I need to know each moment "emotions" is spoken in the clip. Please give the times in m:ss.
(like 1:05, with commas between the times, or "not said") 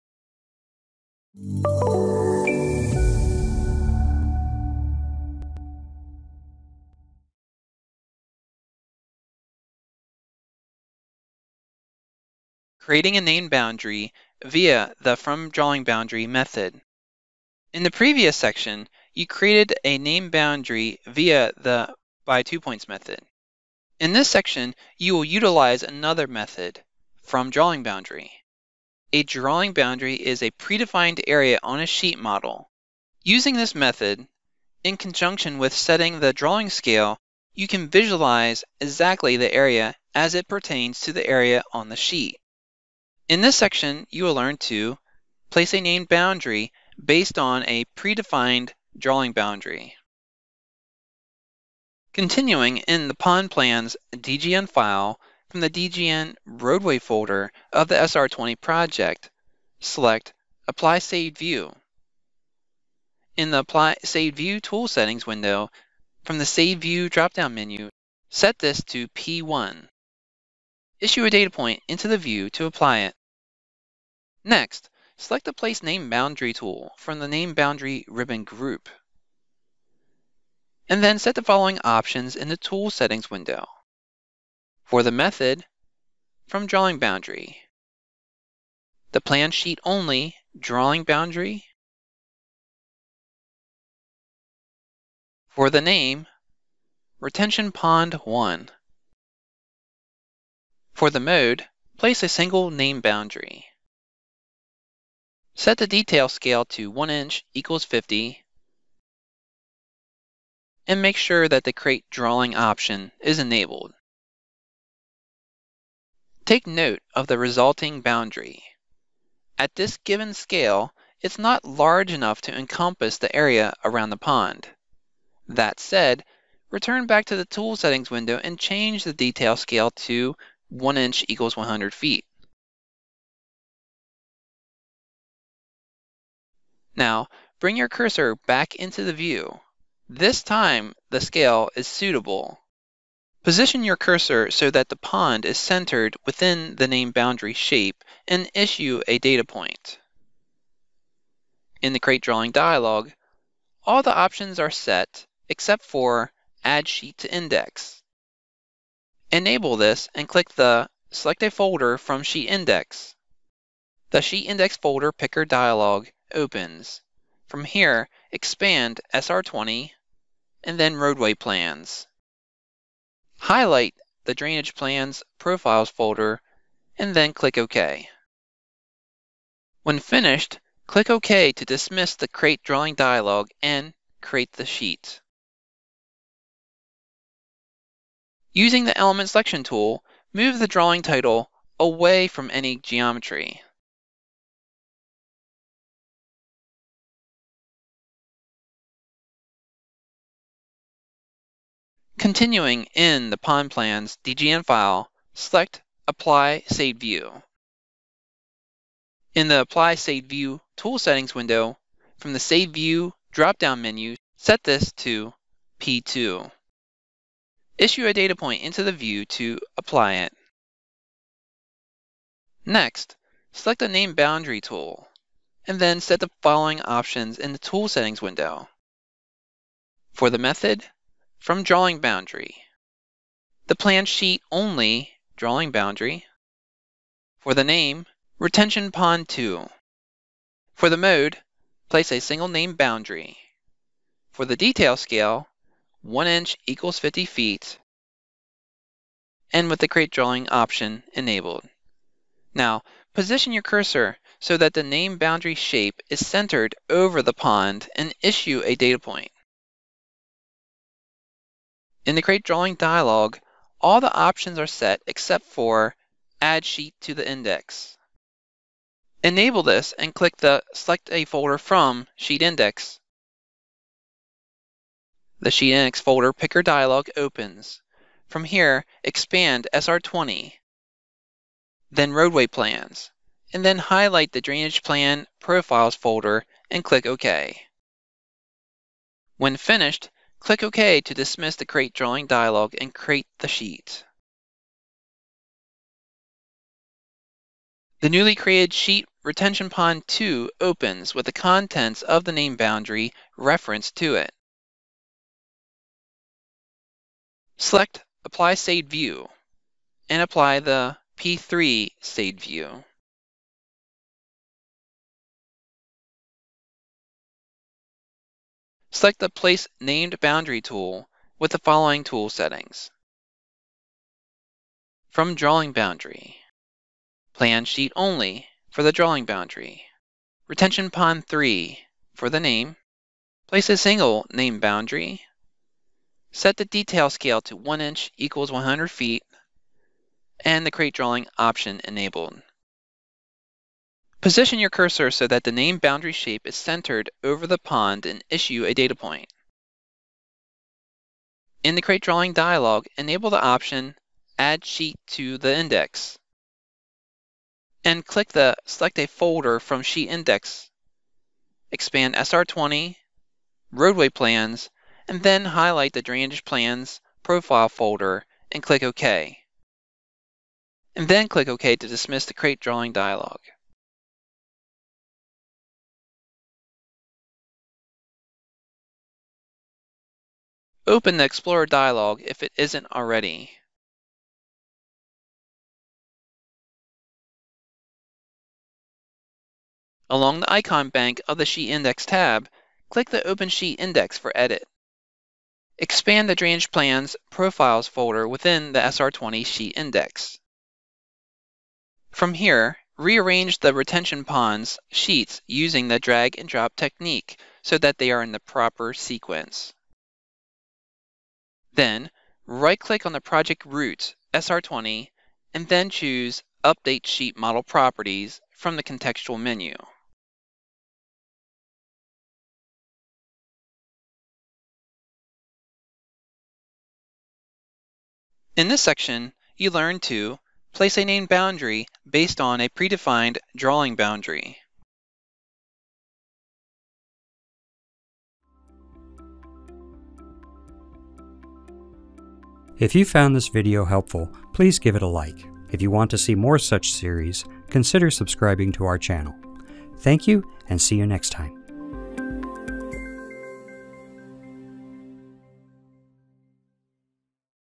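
not said.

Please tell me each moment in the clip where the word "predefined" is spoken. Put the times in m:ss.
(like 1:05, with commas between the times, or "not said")
0:30, 0:47, 7:12.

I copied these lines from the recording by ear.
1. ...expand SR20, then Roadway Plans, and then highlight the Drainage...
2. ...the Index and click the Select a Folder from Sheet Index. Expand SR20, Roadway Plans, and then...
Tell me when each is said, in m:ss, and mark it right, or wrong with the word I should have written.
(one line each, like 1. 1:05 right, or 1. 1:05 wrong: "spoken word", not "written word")
1. 4:39 right
2. 5:55 right.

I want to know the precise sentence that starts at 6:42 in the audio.
From here, rearrange the retention ponds sheets using the drag and drop technique so that they are in the proper sequence.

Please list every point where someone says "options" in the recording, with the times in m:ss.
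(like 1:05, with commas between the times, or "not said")
1:21, 1:52, 2:34, 3:46, 4:10, 4:24, 5:41, 5:53.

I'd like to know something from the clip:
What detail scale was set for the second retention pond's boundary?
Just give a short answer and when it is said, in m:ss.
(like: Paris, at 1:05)
1 inch equals 50 feet, at 4:06.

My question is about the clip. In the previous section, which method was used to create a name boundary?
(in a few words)
By two points.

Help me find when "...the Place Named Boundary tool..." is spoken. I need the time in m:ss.
5:19.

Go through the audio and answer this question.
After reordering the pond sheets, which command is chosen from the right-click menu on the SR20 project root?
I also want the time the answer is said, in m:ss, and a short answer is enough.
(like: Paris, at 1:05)
Update Sheet Model Properties, at 6:56.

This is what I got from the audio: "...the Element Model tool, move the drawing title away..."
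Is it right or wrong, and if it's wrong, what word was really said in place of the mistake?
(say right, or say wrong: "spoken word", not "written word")
wrong: "Selection", not "Model".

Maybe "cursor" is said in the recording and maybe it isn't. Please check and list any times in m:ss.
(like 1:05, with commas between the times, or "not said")
2:17, 2:23, 4:13, 5:44.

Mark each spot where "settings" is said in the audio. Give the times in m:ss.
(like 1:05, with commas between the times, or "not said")
0:35, 1:04, 1:22, 2:07, 3:30, 3:47, 5:22.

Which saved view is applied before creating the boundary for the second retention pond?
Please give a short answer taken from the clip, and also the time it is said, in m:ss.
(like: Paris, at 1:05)
P2, at 3:35.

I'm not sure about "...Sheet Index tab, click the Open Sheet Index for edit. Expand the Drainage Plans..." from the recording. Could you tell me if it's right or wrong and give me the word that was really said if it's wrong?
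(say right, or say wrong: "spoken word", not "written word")
right.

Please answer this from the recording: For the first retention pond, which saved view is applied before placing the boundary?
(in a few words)
P1.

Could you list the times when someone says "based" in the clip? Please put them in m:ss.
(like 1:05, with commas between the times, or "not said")
0:47, 7:12.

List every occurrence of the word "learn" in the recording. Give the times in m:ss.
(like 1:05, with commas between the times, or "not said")
0:44, 7:09.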